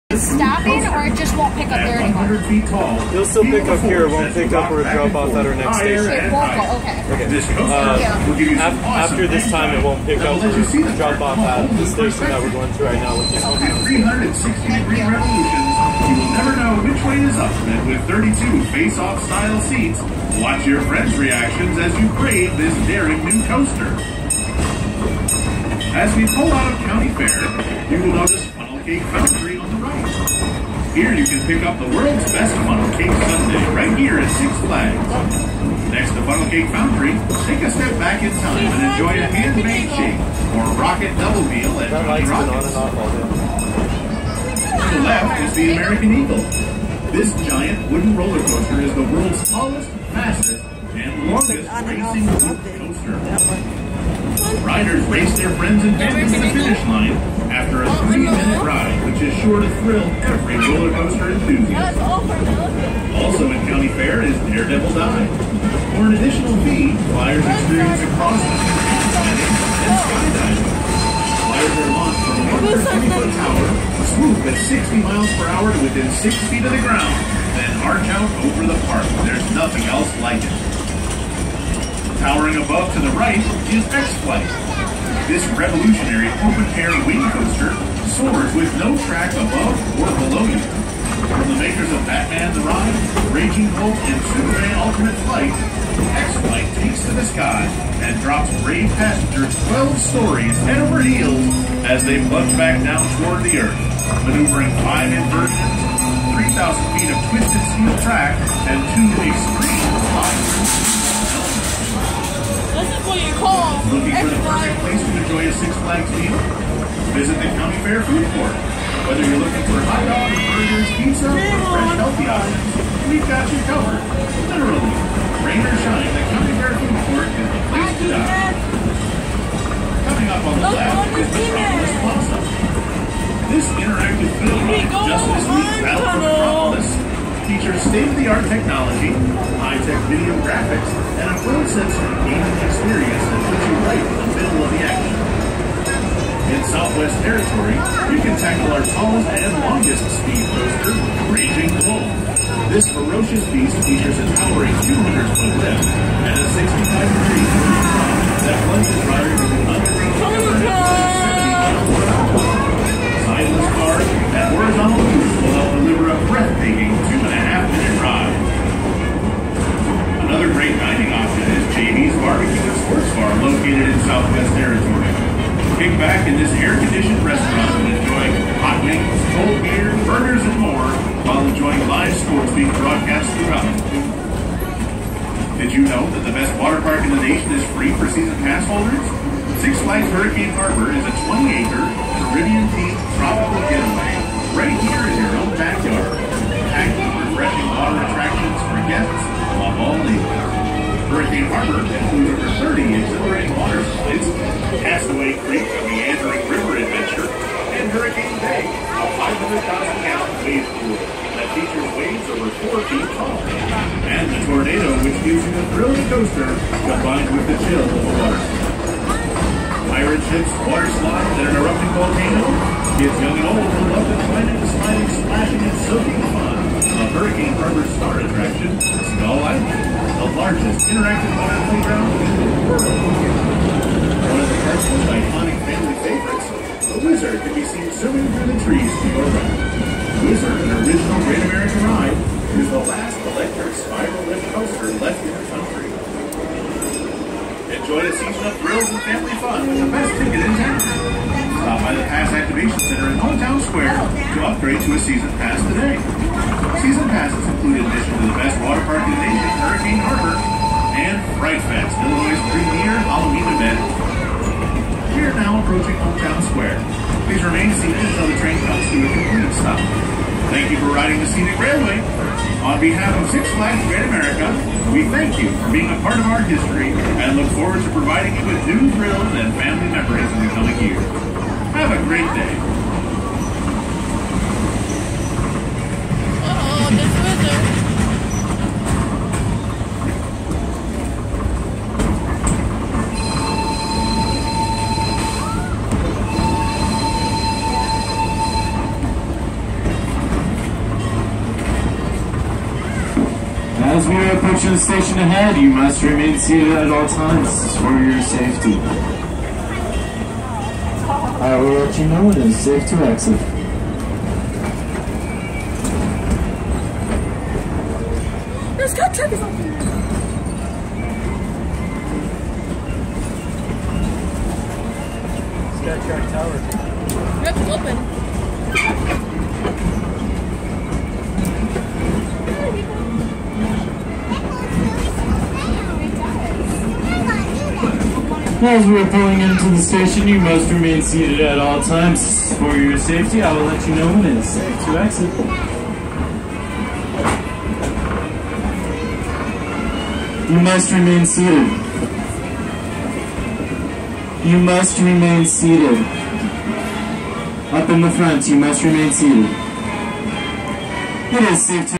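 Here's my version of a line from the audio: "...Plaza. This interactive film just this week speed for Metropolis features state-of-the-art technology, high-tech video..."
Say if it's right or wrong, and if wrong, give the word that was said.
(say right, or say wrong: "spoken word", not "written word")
wrong: "battled", not "speed".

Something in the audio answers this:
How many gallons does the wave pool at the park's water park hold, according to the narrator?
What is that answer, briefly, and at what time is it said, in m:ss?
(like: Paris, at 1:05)
500,000, at 3:29.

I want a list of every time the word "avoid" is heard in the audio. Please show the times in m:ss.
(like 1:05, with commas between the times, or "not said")
not said.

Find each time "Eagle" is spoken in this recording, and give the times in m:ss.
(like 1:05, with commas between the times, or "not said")
0:46.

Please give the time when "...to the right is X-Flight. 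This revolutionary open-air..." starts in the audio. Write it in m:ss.
1:22.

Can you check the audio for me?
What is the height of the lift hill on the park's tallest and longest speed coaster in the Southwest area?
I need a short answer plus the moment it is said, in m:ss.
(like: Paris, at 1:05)
200 feet, at 2:34.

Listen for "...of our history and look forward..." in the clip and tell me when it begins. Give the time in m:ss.
4:36.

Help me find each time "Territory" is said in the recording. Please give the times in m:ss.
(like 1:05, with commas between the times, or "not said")
2:27, 2:54.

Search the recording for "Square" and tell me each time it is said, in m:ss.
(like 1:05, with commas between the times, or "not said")
4:13, 4:26.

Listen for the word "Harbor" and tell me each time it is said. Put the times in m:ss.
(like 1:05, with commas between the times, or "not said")
3:10, 3:47, 4:20.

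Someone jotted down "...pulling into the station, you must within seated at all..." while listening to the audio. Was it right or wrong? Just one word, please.
wrong.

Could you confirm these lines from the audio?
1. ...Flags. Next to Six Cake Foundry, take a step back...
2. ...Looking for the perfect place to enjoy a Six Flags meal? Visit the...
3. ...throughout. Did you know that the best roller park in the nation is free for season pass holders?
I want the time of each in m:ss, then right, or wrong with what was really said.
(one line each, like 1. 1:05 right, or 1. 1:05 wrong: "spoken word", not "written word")
1. 0:34 wrong: "Funnel", not "Six"
2. 1:53 right
3. 3:03 wrong: "water", not "roller".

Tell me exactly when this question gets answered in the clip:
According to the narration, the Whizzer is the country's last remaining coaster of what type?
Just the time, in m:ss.
4:03.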